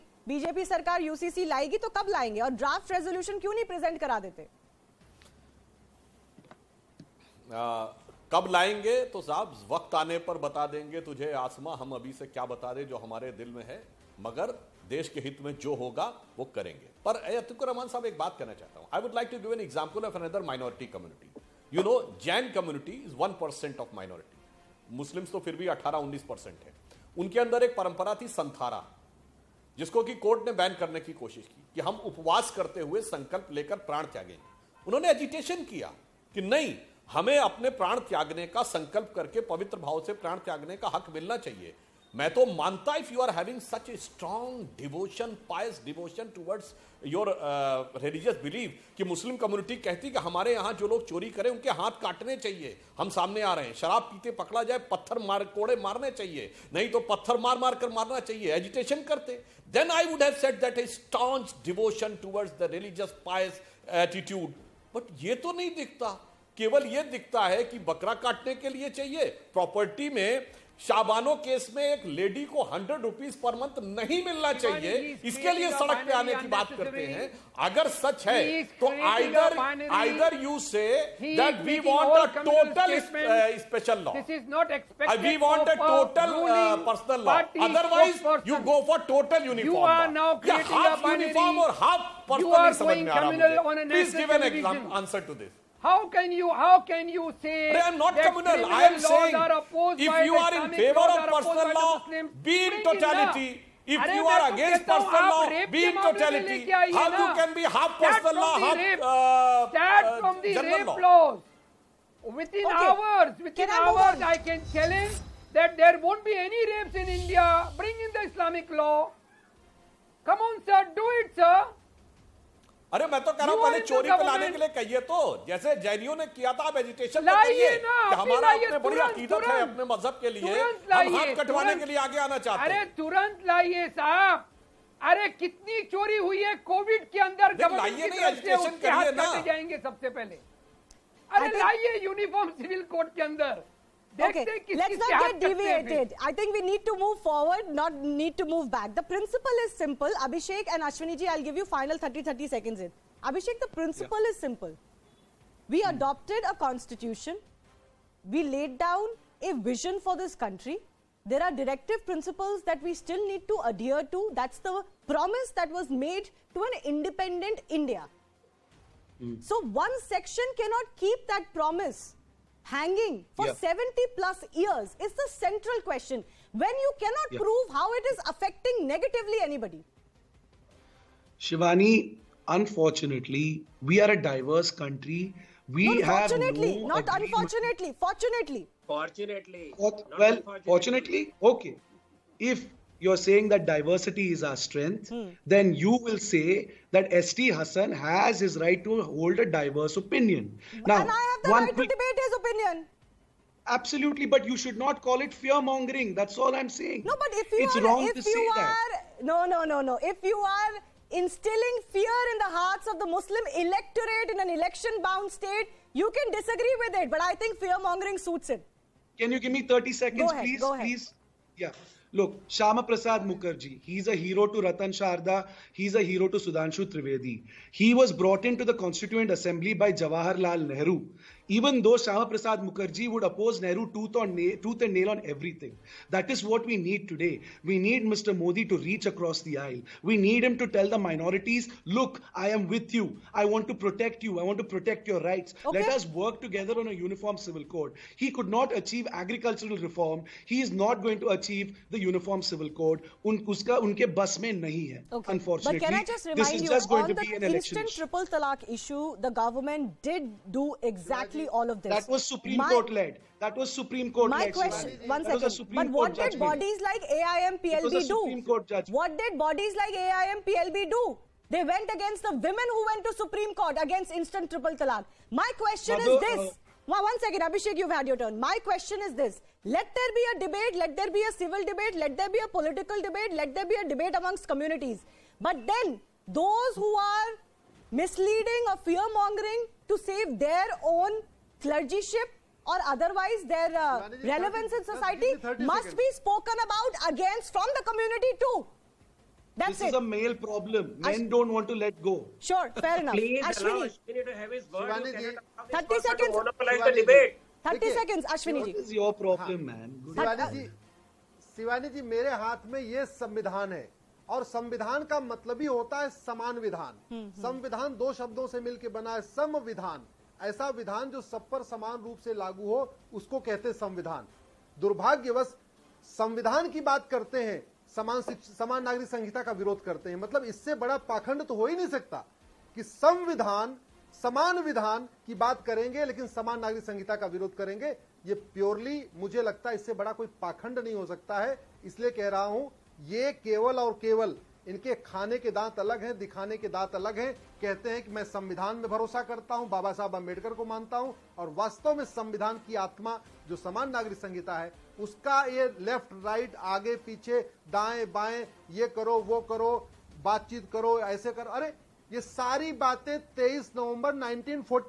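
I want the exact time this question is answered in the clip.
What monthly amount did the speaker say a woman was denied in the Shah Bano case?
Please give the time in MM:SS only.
01:12.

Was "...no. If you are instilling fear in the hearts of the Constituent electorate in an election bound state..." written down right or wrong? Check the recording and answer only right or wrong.
wrong.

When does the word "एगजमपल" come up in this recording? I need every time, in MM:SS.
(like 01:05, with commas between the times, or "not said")
00:19, 01:34.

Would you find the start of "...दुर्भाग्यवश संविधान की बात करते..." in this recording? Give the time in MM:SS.
05:24.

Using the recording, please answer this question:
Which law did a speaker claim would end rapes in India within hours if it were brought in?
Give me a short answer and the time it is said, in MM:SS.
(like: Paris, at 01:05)
Islamic law, at 01:58.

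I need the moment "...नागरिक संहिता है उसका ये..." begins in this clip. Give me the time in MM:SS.
05:53.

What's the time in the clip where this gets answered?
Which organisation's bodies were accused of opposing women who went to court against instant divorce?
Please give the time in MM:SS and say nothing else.
04:29.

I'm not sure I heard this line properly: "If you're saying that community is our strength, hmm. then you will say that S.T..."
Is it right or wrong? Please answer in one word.
wrong.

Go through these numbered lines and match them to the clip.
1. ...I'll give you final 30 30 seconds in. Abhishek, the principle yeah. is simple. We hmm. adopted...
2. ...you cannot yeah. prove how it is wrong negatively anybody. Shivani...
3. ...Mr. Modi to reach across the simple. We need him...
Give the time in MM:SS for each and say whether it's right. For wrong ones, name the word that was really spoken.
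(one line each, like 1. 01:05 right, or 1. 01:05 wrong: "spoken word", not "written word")
1. 02:31 right
2. 02:56 wrong: "affecting", not "wrong"
3. 03:58 wrong: "aisle", not "simple".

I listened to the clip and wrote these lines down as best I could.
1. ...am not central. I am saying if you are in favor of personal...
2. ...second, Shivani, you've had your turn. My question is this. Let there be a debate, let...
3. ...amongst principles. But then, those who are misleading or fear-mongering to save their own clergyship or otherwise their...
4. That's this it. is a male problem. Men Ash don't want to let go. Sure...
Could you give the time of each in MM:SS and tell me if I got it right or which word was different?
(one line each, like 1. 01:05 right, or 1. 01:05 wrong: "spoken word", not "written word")
1. 01:37 wrong: "communal", not "central"
2. 04:37 wrong: "Abhishek", not "Shivani"
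3. 04:44 wrong: "communities", not "principles"
4. 04:59 right.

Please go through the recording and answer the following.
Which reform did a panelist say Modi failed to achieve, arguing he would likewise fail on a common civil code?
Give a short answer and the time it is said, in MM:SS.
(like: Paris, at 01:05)
agricultural reform, at 04:09.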